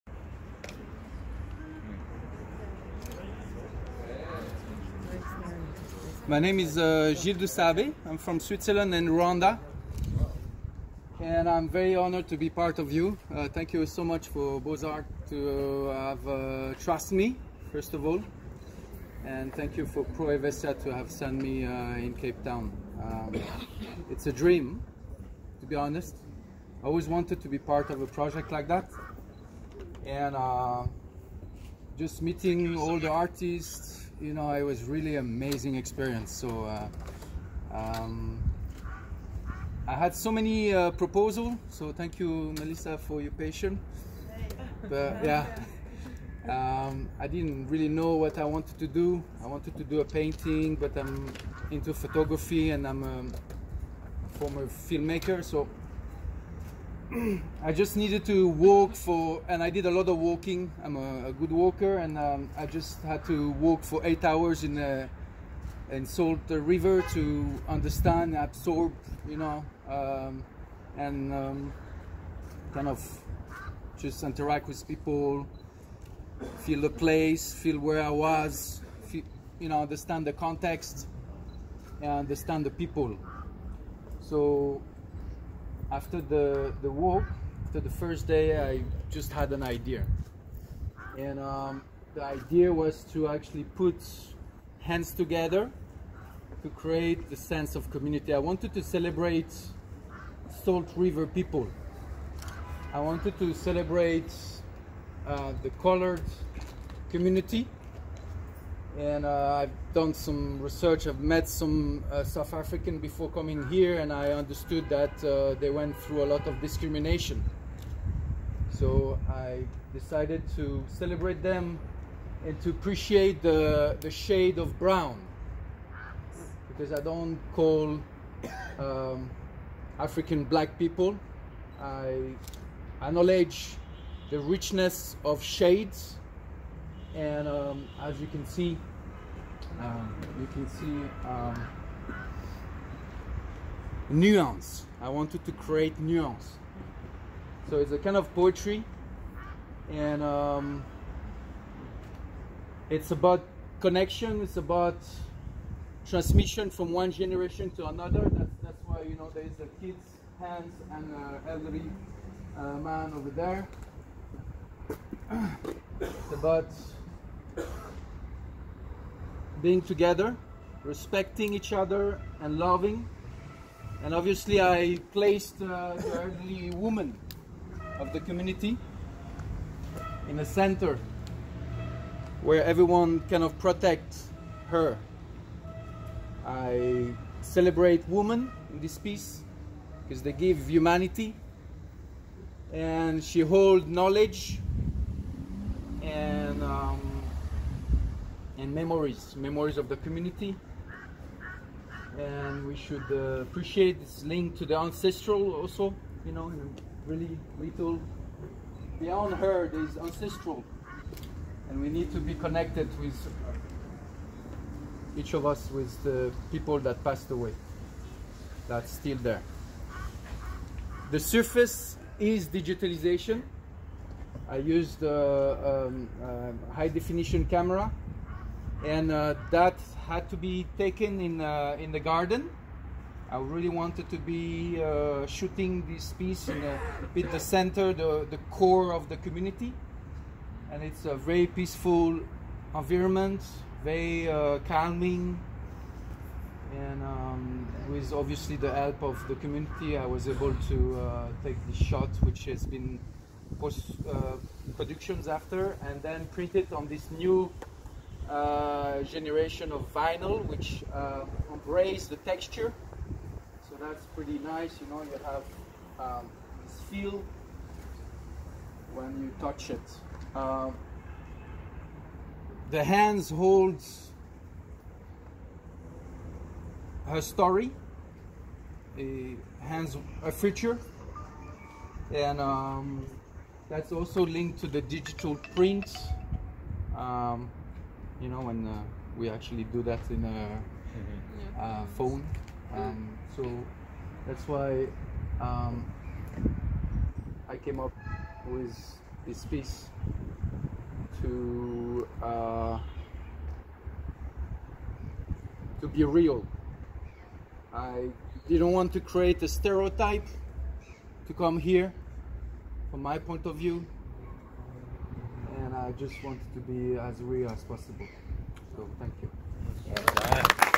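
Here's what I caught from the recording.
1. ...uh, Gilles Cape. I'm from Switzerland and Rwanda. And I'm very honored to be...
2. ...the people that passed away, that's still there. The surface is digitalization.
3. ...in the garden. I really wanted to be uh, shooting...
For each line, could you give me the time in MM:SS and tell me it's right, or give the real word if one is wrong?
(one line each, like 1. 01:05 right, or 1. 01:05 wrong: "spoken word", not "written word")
1. 00:06 wrong: "Dusabe", not "Cape"
2. 03:36 right
3. 03:51 right.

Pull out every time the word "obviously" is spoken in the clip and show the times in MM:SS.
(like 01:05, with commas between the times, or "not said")
02:54, 04:08.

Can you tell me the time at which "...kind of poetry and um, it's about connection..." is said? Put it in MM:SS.
02:27.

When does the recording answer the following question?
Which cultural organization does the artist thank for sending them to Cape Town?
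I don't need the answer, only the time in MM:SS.
00:20.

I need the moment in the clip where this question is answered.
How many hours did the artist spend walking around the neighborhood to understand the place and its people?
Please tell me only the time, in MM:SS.
01:04.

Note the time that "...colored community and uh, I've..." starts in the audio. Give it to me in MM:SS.
01:45.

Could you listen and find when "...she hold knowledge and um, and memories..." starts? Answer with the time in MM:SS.
03:13.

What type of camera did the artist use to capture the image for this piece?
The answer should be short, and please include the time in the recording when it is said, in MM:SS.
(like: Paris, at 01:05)
High definition camera, at 03:46.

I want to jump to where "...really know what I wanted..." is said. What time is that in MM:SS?
00:47.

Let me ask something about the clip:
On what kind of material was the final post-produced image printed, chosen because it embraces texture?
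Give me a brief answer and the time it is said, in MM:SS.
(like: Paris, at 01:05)
Vinyl, at 04:19.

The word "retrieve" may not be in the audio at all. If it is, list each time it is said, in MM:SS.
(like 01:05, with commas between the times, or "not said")
not said.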